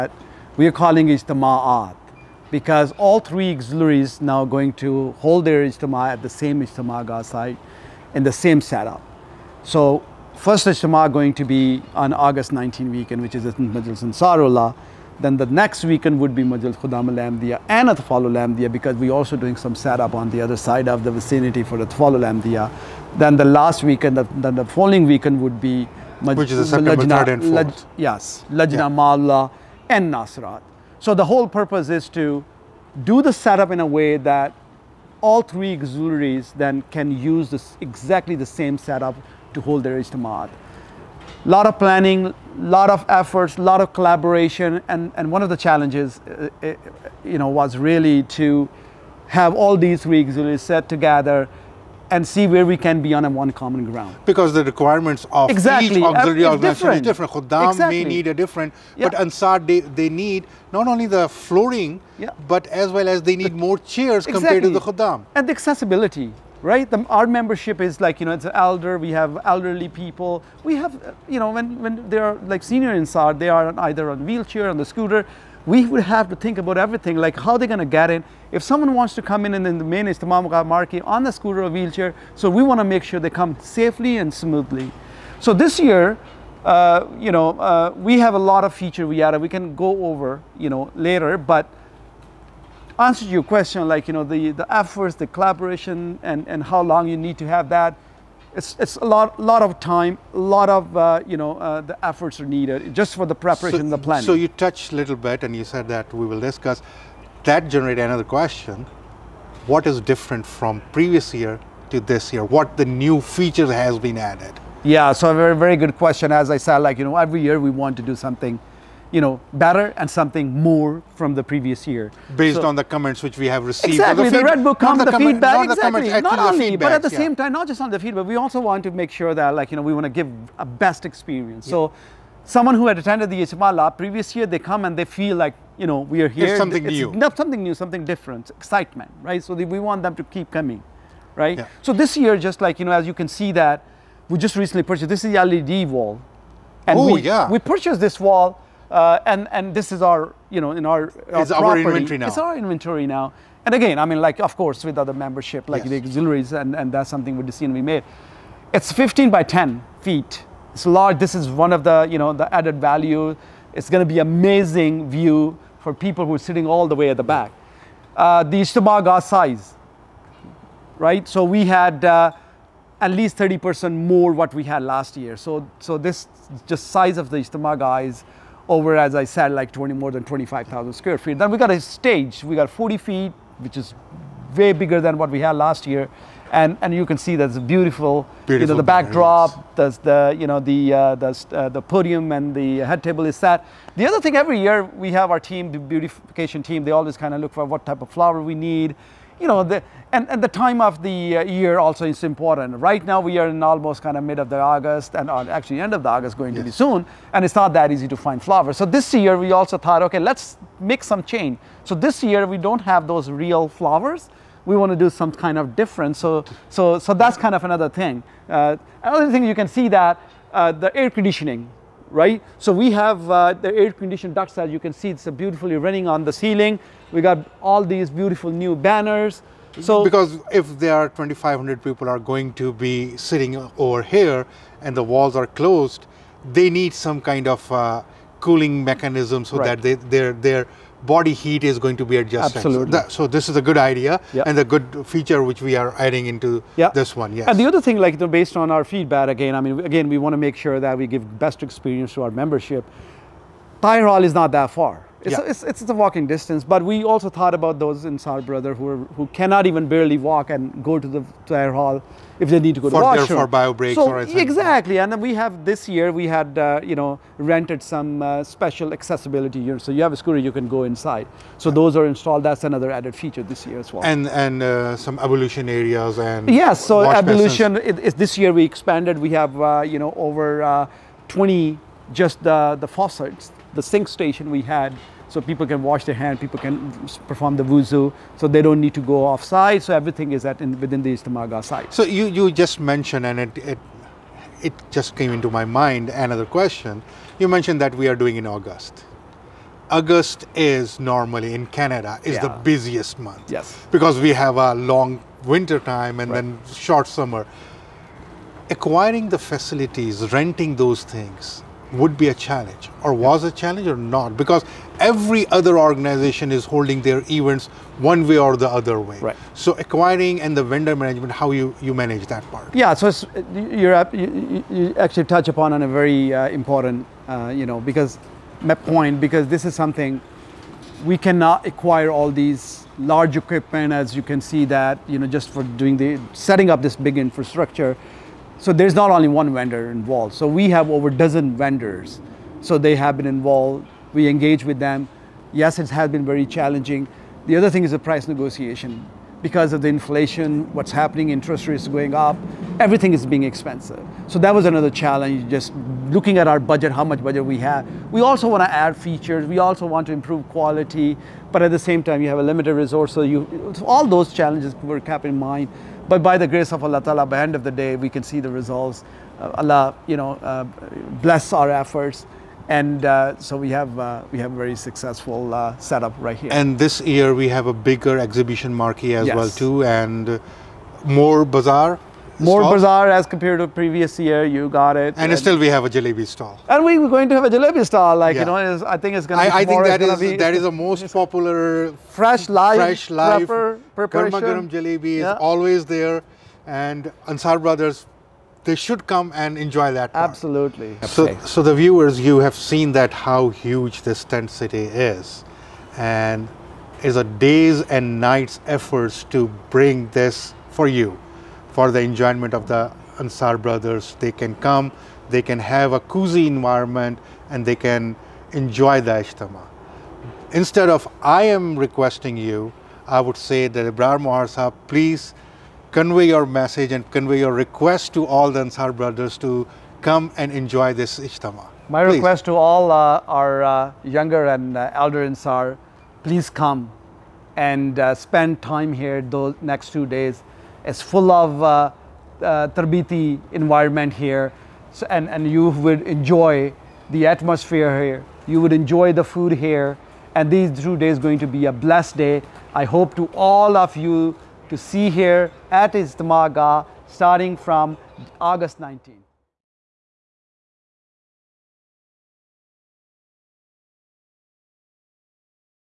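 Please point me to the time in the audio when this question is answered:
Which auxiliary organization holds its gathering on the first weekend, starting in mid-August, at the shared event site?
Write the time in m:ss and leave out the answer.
0:13.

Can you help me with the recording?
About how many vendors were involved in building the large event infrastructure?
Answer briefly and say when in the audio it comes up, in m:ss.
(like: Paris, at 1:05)
over a dozen, at 5:40.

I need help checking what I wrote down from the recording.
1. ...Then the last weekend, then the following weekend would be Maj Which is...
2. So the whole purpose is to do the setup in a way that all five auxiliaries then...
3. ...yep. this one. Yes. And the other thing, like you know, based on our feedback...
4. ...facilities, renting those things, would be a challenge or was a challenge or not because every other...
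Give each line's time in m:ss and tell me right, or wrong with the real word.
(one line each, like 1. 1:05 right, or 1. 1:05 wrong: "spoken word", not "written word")
1. 0:23 right
2. 0:30 wrong: "three", not "five"
3. 4:06 right
4. 5:09 right.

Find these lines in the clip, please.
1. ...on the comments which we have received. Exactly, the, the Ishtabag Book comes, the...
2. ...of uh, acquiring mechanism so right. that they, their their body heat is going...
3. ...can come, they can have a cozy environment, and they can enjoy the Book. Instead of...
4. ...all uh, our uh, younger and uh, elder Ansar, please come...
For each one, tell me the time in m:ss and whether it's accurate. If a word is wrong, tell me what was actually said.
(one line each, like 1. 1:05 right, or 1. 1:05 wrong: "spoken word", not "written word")
1. 2:02 wrong: "Red", not "Ishtabag"
2. 3:57 wrong: "cooling", not "acquiring"
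3. 6:54 wrong: "Ijtima", not "Book"
4. 7:12 right.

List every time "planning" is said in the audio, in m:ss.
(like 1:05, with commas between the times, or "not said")
0:41, 1:43.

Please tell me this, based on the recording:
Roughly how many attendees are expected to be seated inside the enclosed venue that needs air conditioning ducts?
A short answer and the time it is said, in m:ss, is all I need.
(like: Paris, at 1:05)
2,500, at 3:51.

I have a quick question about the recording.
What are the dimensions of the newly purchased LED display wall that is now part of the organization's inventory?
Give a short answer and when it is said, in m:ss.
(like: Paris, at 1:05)
15 by 10 feet, at 2:38.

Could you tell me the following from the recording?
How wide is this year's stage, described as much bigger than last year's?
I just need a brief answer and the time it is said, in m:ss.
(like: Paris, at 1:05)
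40 feet, at 3:02.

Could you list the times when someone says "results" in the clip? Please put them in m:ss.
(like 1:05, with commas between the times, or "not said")
6:08.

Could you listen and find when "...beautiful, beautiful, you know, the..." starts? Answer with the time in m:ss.
3:07.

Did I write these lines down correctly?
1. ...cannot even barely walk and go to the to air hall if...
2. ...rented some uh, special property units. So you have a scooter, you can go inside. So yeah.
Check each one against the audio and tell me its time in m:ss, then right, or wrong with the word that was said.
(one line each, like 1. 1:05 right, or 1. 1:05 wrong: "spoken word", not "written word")
1. 4:19 right
2. 4:27 wrong: "accessibility", not "property".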